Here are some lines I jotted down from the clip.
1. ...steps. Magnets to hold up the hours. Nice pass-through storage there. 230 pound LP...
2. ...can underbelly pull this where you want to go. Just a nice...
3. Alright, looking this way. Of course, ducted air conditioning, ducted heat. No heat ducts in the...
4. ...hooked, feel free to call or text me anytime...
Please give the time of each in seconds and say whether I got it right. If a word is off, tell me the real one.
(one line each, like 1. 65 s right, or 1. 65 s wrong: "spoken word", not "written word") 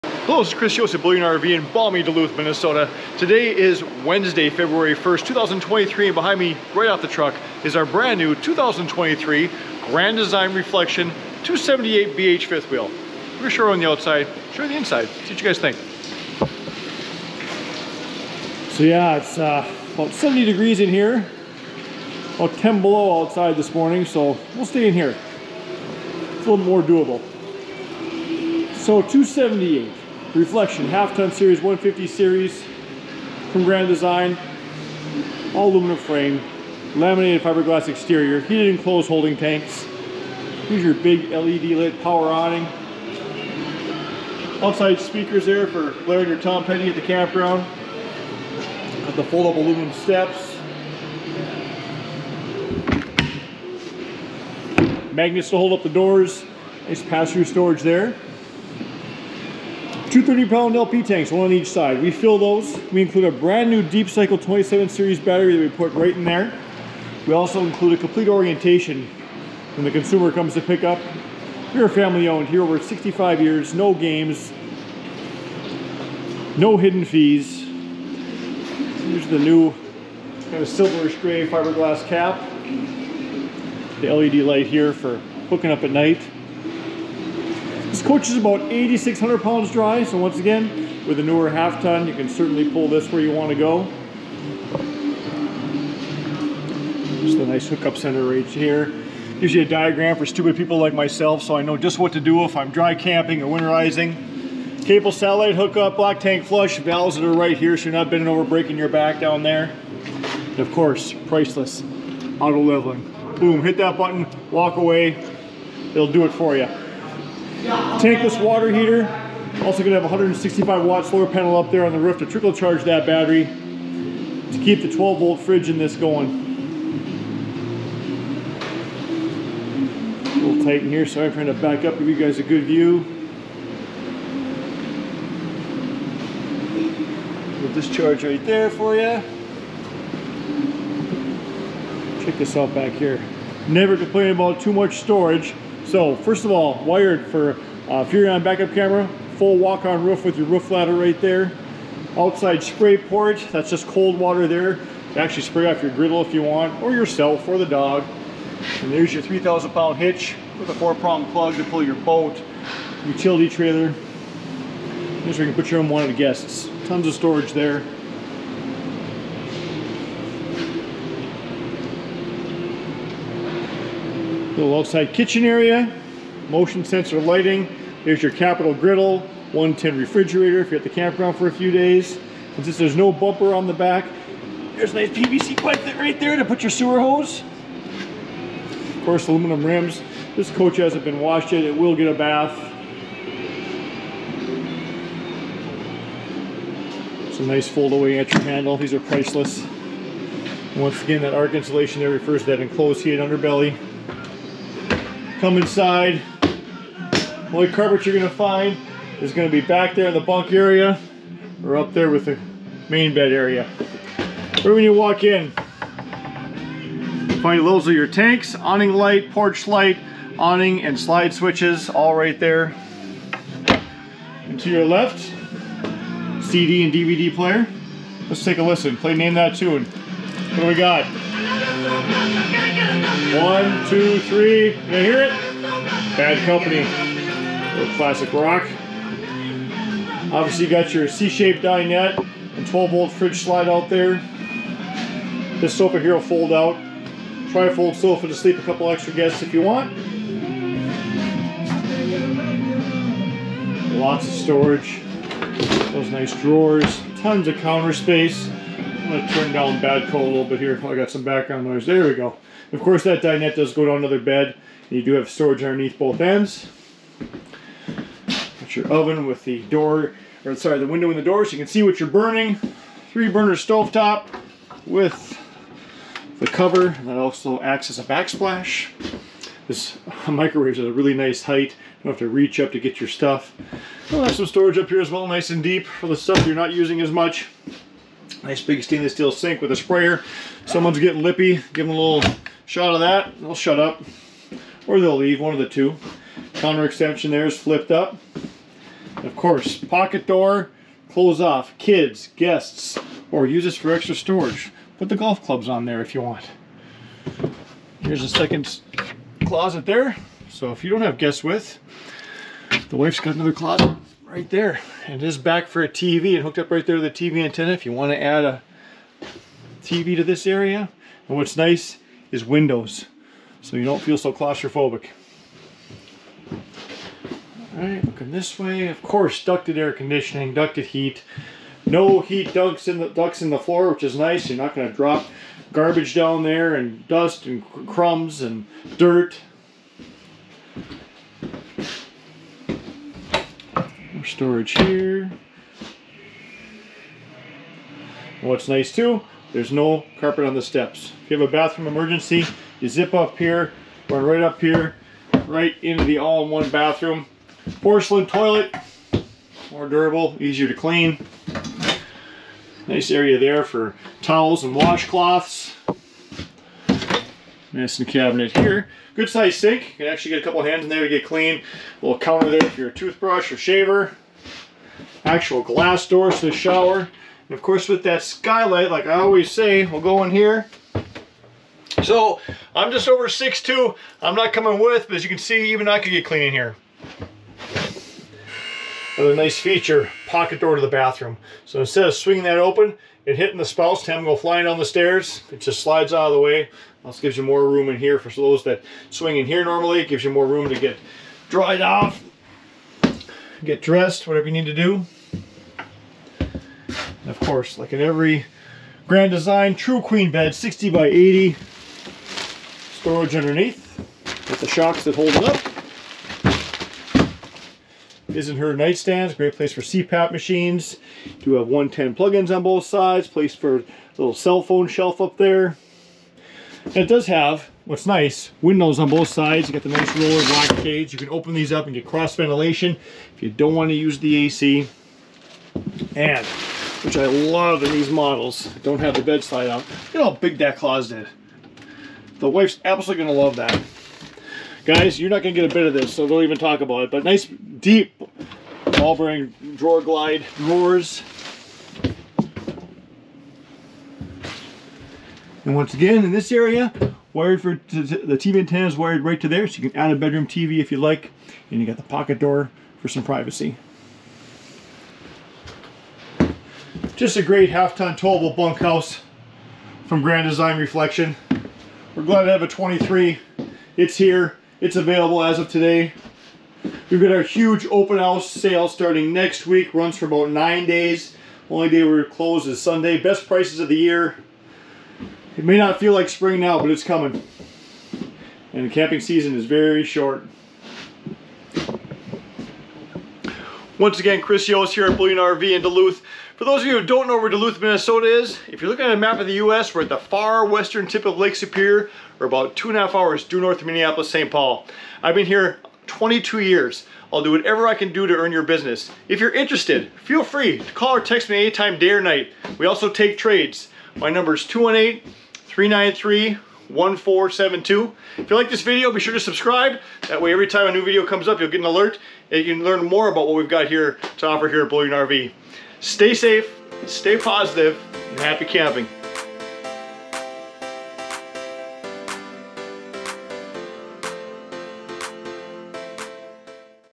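1. 49 s wrong: "doors", not "hours"
2. 92 s wrong: "certainly", not "underbelly"
3. 327 s right
4. 509 s wrong: "interested", not "hooked".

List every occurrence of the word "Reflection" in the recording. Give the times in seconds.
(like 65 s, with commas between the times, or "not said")
10 s, 30 s, 470 s.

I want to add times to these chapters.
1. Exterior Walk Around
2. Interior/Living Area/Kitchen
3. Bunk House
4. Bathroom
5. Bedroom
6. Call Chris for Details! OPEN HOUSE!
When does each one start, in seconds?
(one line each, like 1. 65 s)
1. 29 s
2. 200 s
3. 299 s
4. 355 s
5. 405 s
6. 465 s.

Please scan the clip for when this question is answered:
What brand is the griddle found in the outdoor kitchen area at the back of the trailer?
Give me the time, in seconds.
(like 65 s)
178 s.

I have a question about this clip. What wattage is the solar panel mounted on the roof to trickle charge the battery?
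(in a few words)
165 watt.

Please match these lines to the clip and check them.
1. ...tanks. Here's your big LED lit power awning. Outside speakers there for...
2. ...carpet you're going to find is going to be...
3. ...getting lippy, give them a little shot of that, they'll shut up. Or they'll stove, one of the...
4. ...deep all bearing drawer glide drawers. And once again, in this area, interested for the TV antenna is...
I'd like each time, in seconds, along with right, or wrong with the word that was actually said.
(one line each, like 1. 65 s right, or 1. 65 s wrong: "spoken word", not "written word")
1. 39 s right
2. 207 s right
3. 290 s wrong: "leave", not "stove"
4. 447 s wrong: "wired", not "interested".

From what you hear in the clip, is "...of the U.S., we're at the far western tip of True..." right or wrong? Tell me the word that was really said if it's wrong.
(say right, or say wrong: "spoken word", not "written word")
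wrong: "Lake", not "True".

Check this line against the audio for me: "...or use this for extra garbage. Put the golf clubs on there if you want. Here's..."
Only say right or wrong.
wrong.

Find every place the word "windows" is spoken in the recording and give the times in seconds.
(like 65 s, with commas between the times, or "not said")
270 s, 322 s, 428 s.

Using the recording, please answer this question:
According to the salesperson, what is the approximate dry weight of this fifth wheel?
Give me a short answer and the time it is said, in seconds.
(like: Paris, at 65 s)
8,600 pounds, at 88 s.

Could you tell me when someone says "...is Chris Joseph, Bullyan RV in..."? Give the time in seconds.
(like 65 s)
0 s.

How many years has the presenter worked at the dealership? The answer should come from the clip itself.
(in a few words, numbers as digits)
22 years.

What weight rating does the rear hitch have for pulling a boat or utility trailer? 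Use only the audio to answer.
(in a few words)
3,000 pound.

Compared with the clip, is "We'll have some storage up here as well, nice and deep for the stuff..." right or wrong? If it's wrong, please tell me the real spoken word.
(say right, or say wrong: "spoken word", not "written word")
right.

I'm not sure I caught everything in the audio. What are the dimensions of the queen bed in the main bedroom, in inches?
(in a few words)
60 by 80.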